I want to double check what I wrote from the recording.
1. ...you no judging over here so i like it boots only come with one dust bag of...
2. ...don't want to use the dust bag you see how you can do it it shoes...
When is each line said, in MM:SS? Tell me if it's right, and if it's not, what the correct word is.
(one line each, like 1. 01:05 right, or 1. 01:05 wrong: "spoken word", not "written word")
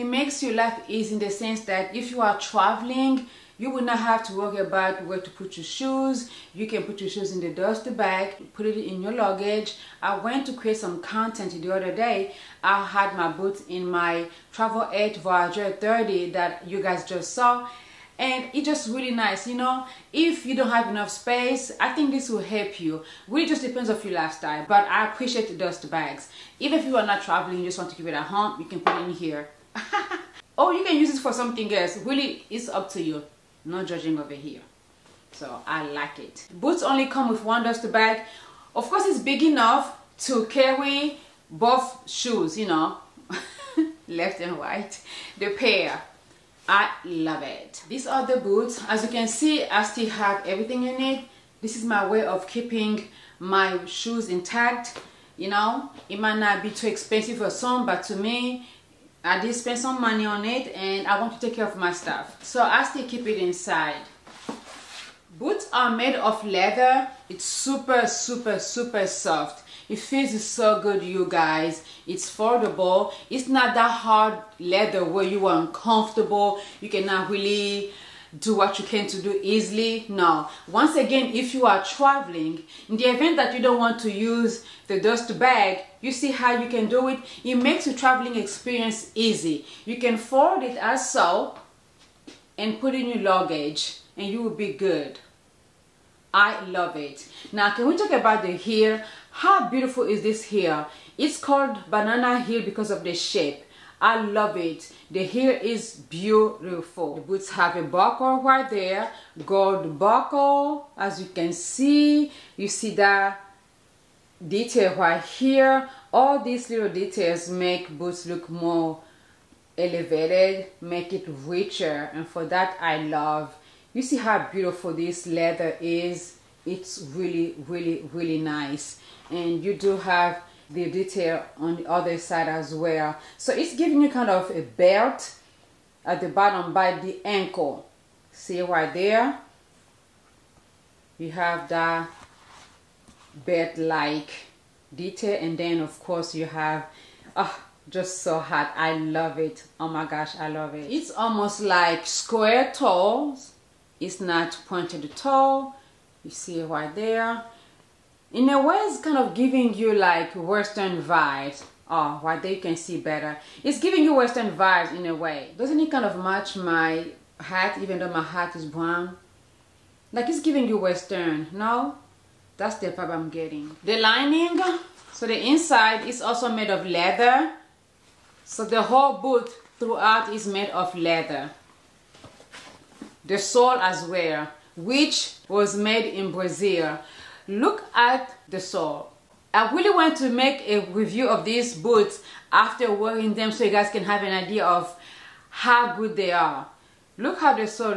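1. 00:33 right
2. 01:23 wrong: "makes", not "shoes".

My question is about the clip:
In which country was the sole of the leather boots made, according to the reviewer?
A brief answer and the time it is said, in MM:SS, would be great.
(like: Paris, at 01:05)
Brazil, at 03:06.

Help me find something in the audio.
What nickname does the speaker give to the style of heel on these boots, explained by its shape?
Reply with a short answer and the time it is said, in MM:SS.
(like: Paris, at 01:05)
Banana heel, at 01:41.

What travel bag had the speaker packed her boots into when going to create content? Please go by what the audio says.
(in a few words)
Travel 8 Voyager 30.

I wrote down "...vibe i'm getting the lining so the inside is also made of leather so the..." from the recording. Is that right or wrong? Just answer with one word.
right.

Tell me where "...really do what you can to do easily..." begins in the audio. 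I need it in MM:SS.
01:17.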